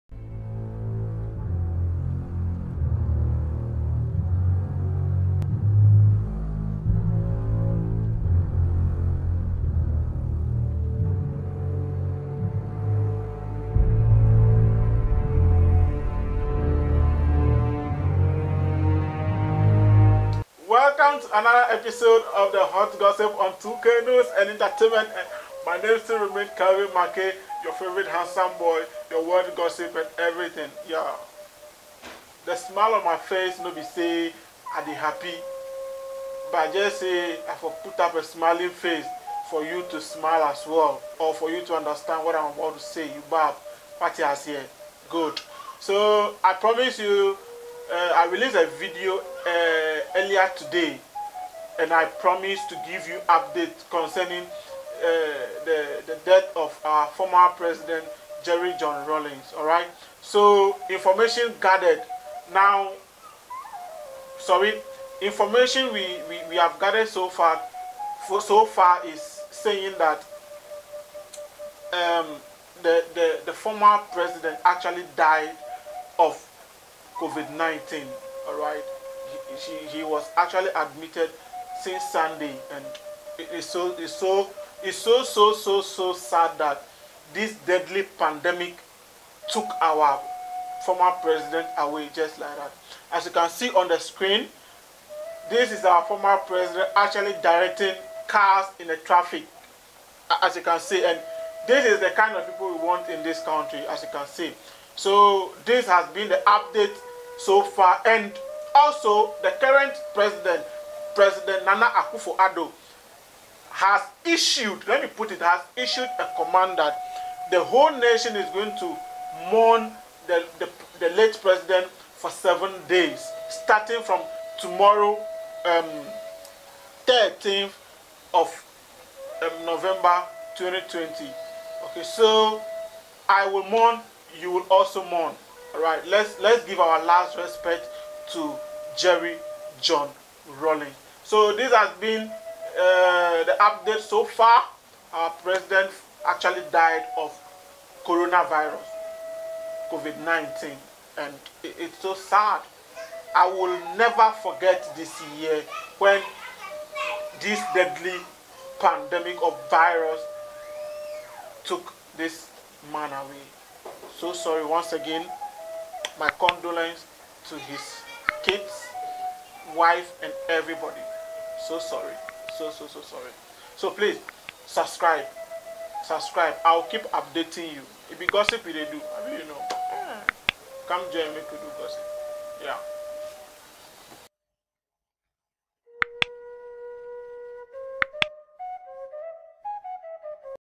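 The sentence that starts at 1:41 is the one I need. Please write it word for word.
And this is the kind of people we want in this country, as you can see.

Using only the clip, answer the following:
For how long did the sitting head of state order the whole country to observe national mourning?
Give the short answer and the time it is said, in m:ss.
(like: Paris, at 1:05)
7 days, at 2:02.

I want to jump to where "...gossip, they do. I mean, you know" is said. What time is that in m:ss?
2:58.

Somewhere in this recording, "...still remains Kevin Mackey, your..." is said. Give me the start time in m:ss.
0:26.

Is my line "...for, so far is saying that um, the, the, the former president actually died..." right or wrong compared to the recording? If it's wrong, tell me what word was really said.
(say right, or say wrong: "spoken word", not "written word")
right.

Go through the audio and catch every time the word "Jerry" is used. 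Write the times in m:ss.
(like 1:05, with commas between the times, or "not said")
0:58, 2:18.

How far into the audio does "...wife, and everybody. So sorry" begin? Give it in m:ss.
2:49.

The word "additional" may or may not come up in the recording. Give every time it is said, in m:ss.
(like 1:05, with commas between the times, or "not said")
not said.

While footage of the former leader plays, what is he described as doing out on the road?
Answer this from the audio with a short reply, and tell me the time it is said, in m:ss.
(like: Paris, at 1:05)
Directing cars, at 1:37.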